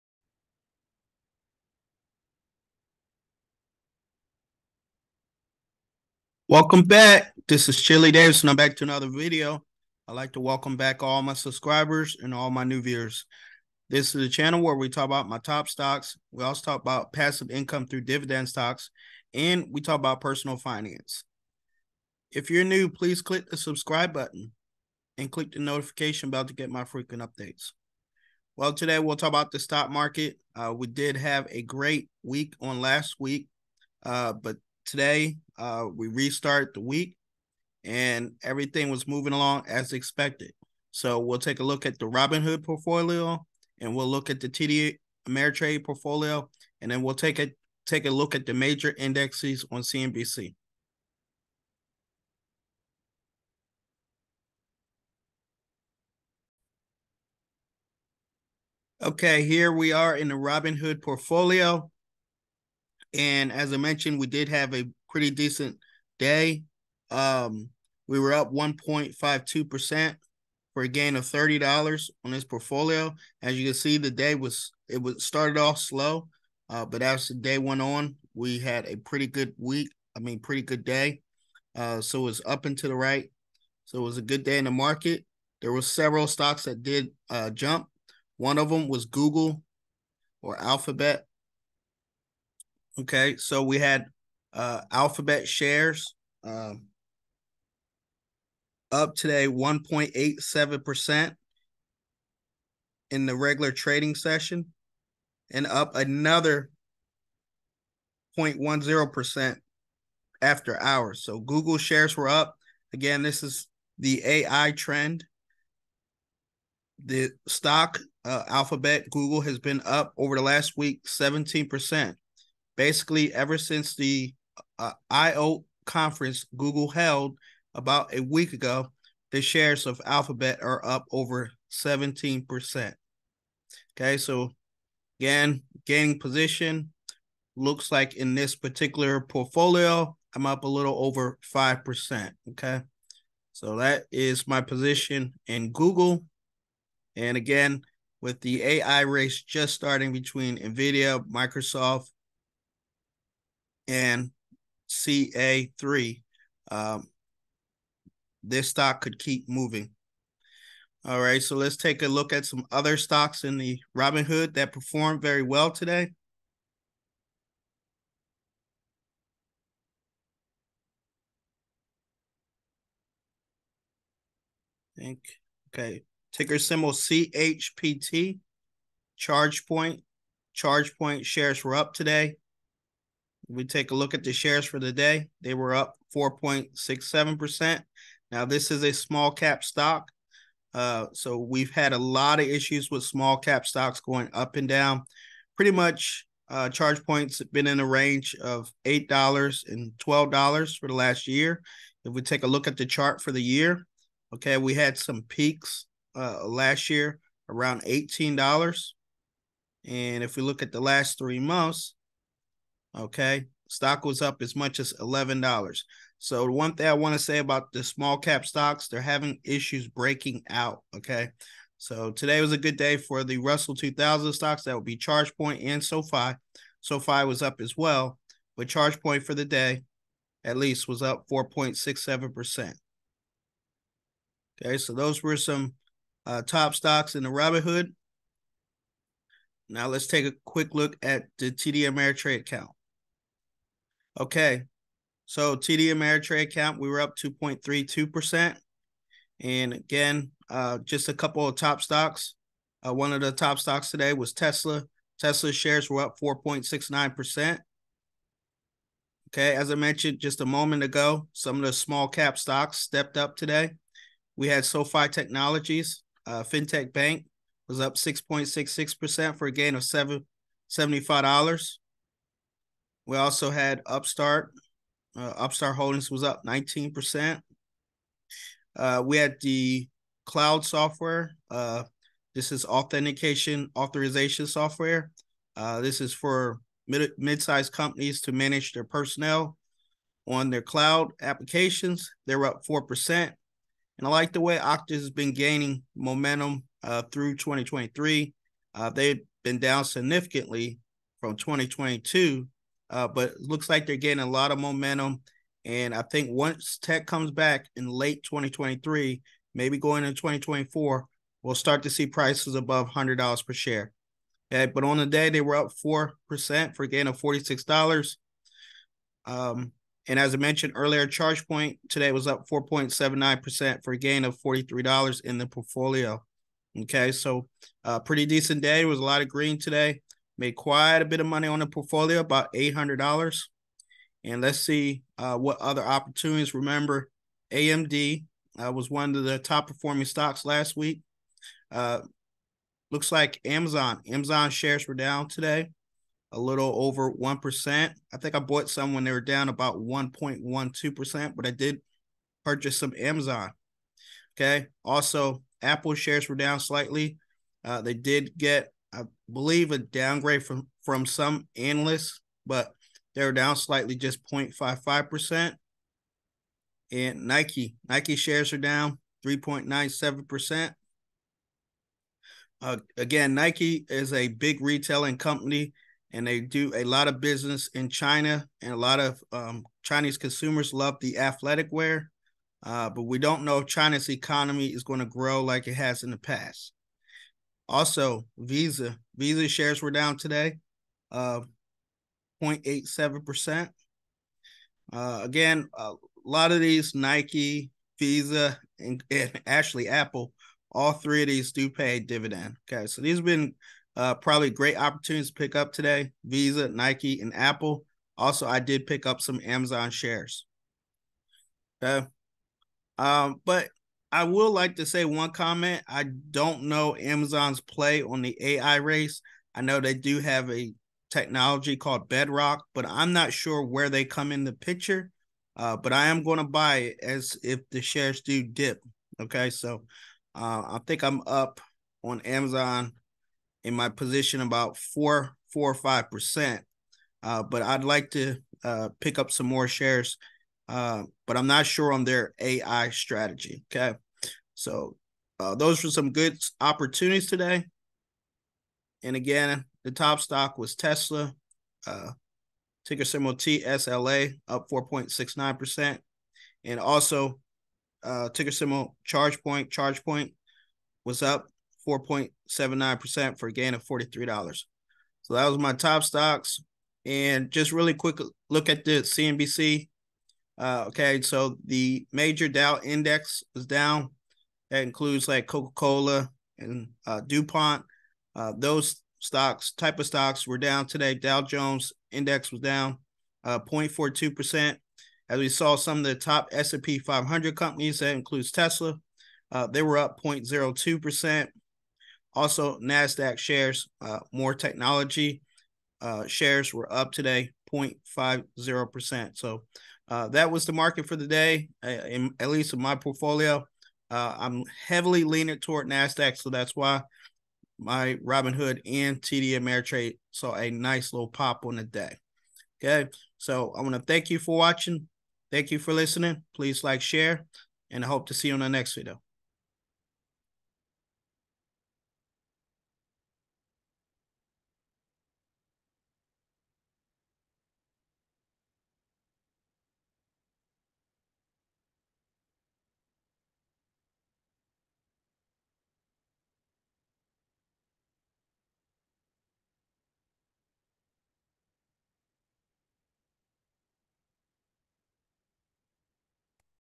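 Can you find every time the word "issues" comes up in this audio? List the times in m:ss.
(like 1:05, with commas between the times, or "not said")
3:12, 3:39.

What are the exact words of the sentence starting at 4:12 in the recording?
Uh, one of the top stocks today was Tesla.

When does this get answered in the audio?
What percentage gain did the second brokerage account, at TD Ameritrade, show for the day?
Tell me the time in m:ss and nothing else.
4:07.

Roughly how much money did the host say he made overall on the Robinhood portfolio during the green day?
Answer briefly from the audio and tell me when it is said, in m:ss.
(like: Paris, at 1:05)
about $800, at 5:32.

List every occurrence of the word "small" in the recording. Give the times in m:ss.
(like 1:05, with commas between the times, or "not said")
3:08, 3:13, 3:37, 4:21.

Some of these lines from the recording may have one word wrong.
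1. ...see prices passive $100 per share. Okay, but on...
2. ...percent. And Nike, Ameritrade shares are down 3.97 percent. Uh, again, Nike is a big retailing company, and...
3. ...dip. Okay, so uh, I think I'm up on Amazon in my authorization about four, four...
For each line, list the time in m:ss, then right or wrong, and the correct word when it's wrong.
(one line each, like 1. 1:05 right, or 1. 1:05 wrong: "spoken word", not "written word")
1. 5:11 wrong: "above", not "passive"
2. 6:05 wrong: "Nike", not "Ameritrade"
3. 7:08 wrong: "position", not "authorization".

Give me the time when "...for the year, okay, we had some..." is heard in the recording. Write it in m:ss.
3:23.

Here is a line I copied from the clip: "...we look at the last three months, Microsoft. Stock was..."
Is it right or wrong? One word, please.
wrong.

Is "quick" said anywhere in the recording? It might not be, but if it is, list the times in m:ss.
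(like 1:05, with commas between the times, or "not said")
4:00, 7:47.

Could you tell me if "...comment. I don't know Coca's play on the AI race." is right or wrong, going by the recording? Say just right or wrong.
wrong.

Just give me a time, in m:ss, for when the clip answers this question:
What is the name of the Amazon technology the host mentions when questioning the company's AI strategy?
7:02.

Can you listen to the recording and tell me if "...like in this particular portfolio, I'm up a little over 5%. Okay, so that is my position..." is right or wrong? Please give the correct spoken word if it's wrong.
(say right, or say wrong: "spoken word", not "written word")
right.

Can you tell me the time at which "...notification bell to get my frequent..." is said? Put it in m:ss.
0:25.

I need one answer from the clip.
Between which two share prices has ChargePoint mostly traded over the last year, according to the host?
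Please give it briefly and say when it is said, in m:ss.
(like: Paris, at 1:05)
$8 and $12, at 3:18.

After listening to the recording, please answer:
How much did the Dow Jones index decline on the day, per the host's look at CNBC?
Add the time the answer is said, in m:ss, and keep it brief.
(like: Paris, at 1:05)
0.42%, at 8:03.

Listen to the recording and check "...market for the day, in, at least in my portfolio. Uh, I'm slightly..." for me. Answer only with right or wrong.
wrong.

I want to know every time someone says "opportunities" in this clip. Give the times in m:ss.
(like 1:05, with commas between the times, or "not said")
5:35, 6:44, 7:26.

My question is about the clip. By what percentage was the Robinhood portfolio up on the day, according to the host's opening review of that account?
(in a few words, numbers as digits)
1.52%.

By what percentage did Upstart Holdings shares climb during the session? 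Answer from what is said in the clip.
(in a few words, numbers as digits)
19%.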